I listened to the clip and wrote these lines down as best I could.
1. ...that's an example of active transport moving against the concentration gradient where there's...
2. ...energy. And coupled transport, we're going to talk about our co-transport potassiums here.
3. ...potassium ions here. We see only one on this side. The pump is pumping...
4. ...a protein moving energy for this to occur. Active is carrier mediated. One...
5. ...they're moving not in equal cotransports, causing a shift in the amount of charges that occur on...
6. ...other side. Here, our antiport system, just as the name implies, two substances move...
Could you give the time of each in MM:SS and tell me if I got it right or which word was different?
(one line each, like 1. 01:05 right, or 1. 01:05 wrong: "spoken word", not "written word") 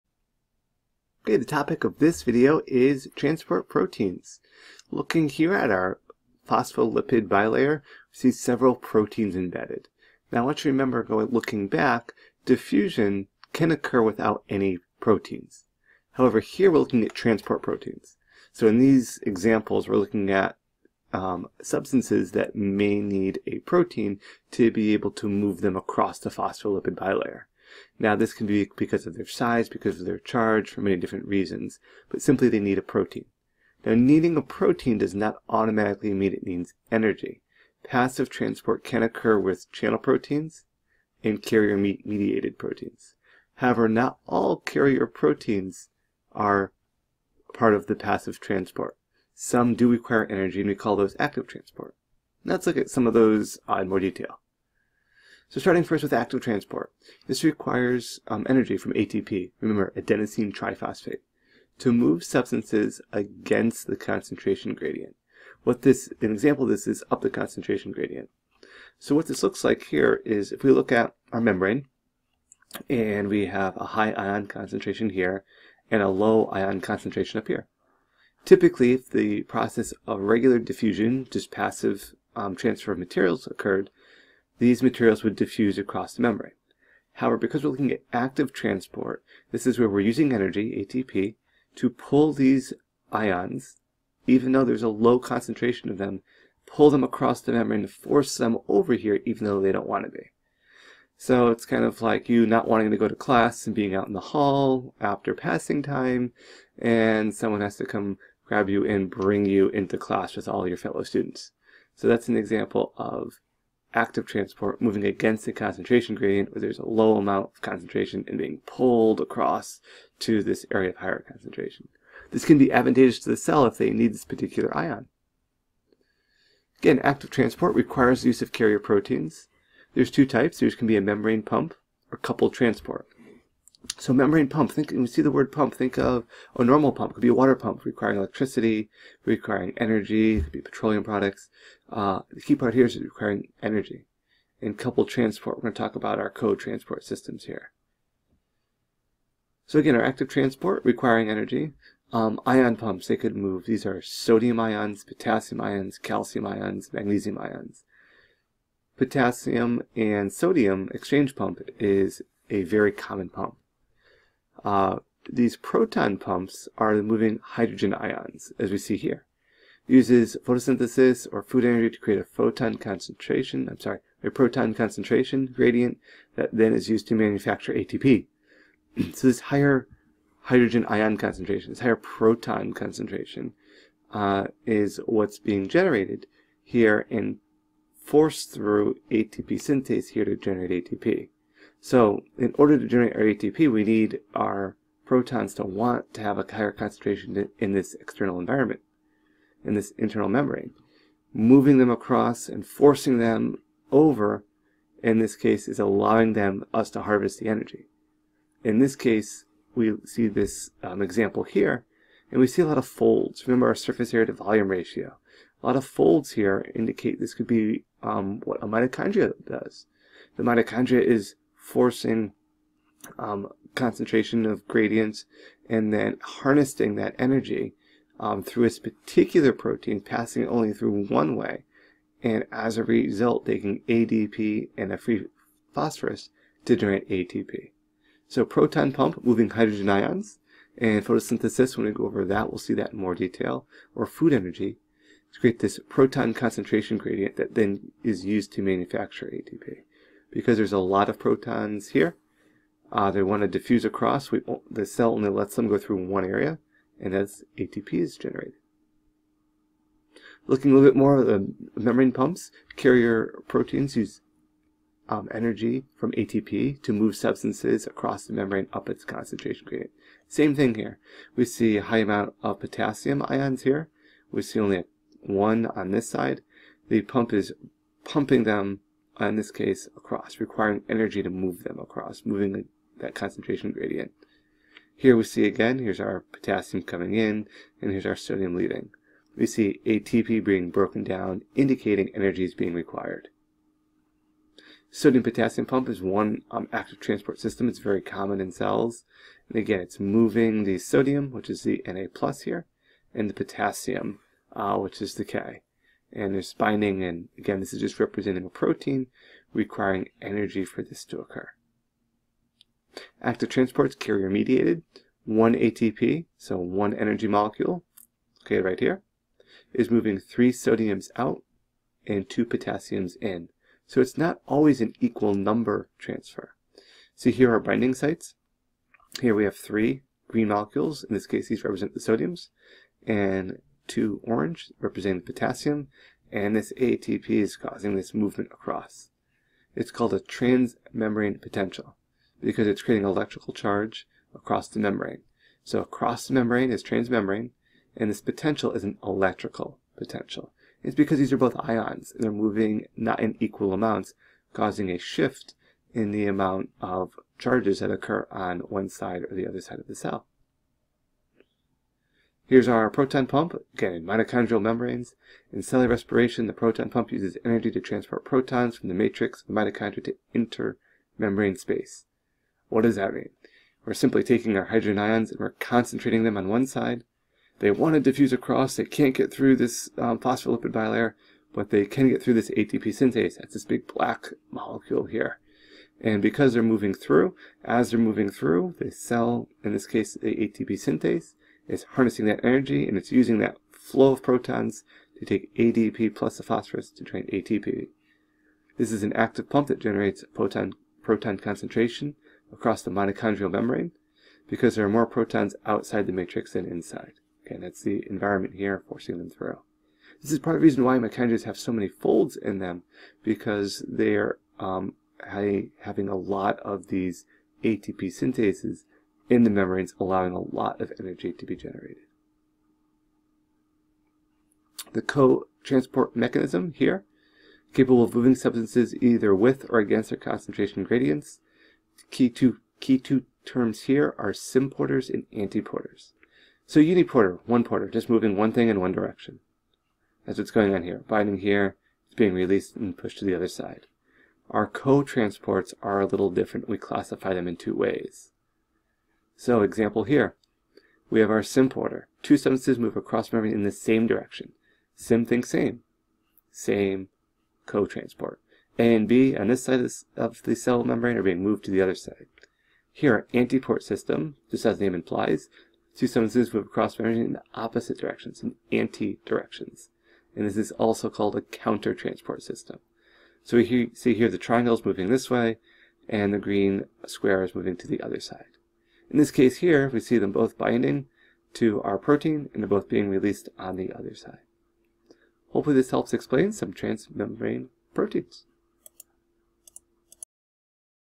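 1. 01:52 right
2. 02:23 wrong: "systems", not "potassiums"
3. 04:32 right
4. 05:08 wrong: "requiring", not "moving"
5. 05:52 wrong: "amounts", not "cotransports"
6. 07:41 right.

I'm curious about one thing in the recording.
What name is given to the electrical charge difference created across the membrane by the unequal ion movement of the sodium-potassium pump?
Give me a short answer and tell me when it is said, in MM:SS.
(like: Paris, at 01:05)
Transmembrane potential, at 05:40.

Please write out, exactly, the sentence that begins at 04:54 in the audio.
Sodium-potassium pump is one um, active transport system.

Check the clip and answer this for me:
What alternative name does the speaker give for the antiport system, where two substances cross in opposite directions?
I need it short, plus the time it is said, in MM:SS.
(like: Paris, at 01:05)
Counter-transport system, at 07:51.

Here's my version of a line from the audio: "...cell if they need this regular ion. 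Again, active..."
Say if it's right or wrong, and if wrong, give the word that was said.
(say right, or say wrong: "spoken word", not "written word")
wrong: "particular", not "regular".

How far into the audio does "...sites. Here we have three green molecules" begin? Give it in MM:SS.
05:27.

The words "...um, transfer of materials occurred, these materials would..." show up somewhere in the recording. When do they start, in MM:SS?
01:22.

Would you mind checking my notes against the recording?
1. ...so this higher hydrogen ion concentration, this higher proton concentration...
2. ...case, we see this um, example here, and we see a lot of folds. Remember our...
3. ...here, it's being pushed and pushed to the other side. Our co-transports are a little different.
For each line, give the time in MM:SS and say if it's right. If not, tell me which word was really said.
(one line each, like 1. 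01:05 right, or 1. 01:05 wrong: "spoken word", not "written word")
1. 02:59 right
2. 03:28 right
3. 07:21 wrong: "released", not "pushed".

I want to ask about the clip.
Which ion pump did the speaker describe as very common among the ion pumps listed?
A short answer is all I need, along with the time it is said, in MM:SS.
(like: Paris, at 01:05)
Potassium and sodium, at 02:38.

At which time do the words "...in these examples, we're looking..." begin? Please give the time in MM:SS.
00:18.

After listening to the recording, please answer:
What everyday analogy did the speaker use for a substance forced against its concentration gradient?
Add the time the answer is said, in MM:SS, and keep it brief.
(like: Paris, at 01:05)
Being out in the hall, at 01:43.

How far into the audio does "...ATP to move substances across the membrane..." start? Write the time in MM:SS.
04:26.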